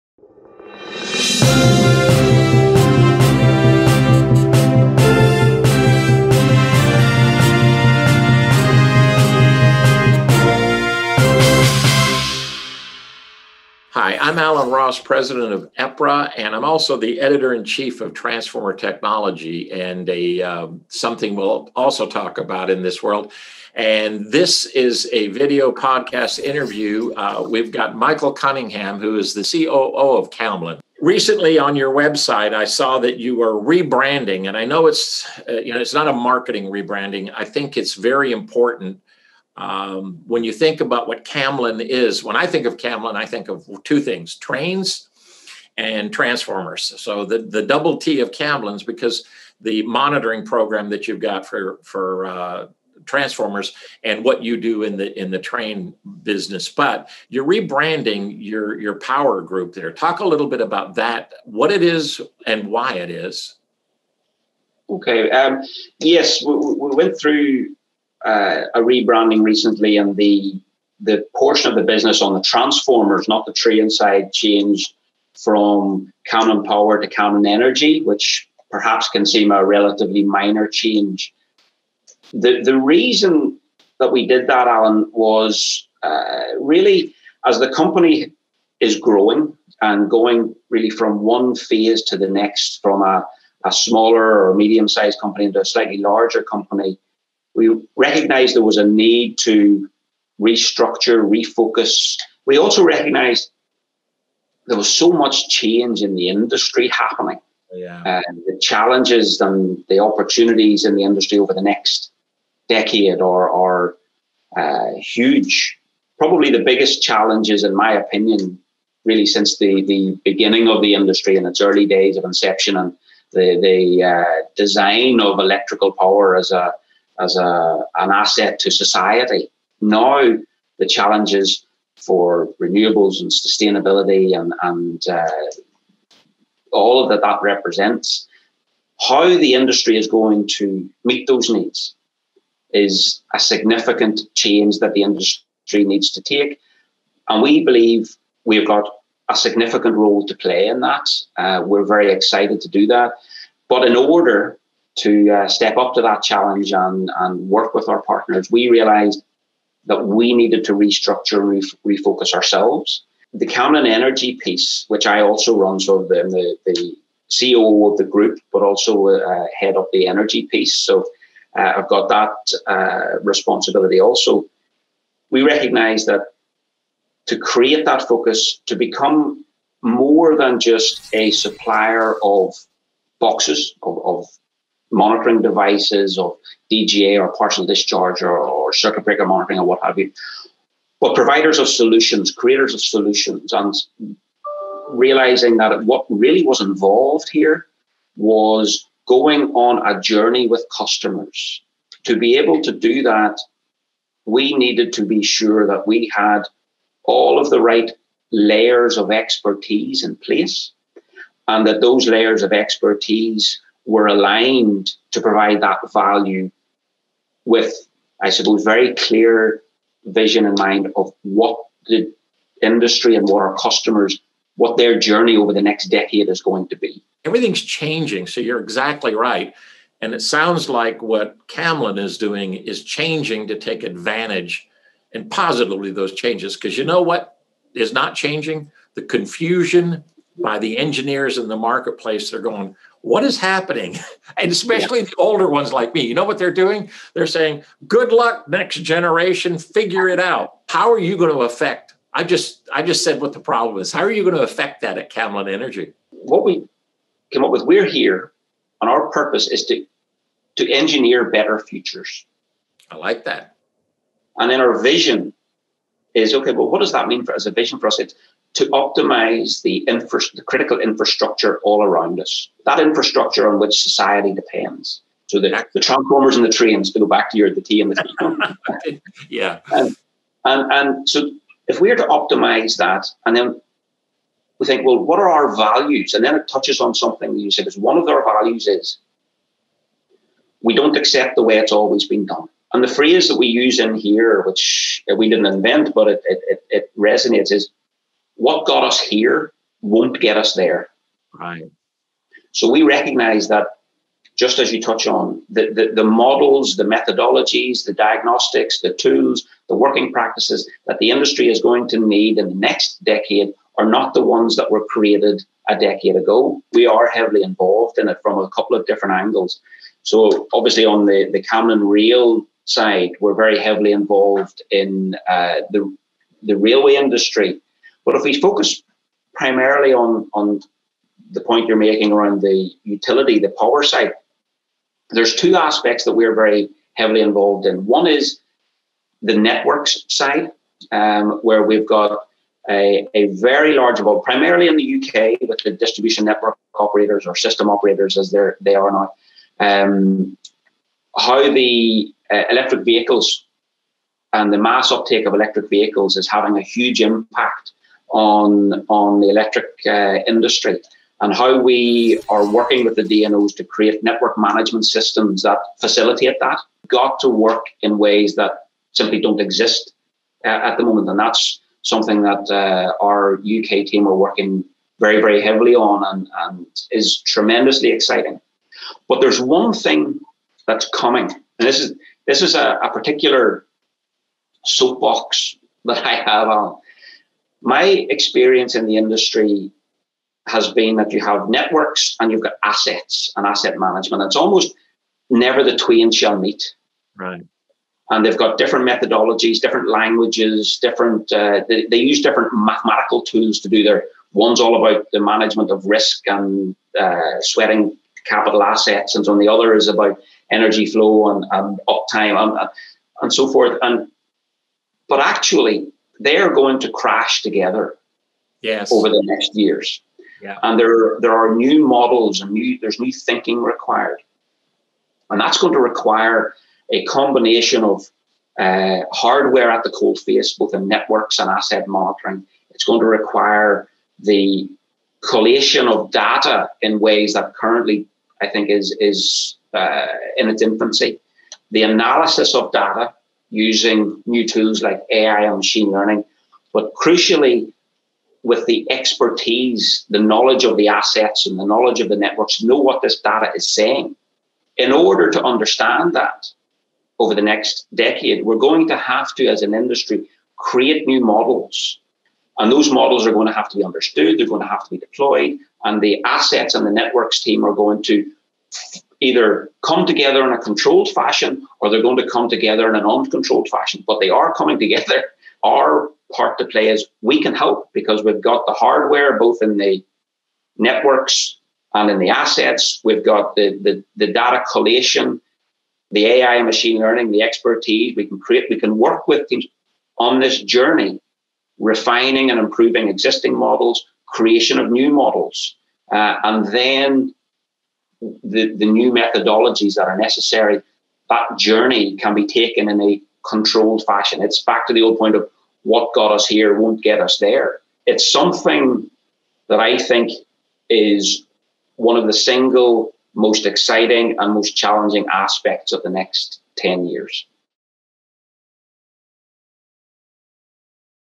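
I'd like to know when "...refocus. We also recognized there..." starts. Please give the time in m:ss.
1:41.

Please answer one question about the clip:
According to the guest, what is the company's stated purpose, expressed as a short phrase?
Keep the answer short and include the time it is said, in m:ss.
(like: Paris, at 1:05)
engineer better futures, at 4:20.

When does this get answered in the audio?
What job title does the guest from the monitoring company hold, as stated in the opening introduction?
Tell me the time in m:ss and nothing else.
0:29.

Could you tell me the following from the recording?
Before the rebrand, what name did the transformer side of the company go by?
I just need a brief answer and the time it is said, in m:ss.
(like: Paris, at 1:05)
Camlin Power, at 1:16.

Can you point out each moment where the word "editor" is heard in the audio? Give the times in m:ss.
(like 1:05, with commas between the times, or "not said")
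0:17.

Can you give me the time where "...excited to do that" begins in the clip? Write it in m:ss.
2:32.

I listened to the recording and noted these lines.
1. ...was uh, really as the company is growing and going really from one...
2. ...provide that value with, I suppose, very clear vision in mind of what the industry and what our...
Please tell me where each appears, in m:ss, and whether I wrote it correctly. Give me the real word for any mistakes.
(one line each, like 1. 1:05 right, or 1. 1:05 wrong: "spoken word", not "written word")
1. 1:25 right
2. 3:35 right.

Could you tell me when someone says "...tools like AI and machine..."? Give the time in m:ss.
7:24.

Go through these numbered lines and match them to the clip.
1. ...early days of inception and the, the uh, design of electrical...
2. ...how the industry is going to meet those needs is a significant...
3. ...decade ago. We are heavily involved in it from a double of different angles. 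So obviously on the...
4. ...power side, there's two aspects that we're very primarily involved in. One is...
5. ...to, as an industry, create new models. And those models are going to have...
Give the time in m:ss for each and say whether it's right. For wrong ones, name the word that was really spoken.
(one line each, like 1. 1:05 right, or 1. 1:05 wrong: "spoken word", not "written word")
1. 2:01 right
2. 2:18 right
3. 5:15 wrong: "couple", not "double"
4. 5:33 wrong: "heavily", not "primarily"
5. 7:39 right.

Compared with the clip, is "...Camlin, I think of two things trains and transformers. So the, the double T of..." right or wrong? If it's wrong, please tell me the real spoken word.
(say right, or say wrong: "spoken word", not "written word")
right.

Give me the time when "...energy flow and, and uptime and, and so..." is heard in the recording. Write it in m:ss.
6:50.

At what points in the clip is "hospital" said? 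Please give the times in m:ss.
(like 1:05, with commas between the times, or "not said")
not said.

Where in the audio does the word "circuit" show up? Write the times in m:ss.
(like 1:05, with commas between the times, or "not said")
3:08.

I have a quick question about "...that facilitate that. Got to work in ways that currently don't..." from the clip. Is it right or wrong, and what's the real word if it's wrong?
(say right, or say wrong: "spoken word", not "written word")
wrong: "simply", not "currently".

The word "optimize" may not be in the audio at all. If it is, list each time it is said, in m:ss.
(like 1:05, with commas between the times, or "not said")
4:28, 4:42.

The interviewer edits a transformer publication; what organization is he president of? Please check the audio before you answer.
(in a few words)
EPRA.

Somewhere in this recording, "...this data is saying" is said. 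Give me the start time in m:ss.
7:33.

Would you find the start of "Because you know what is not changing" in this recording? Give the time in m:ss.
3:56.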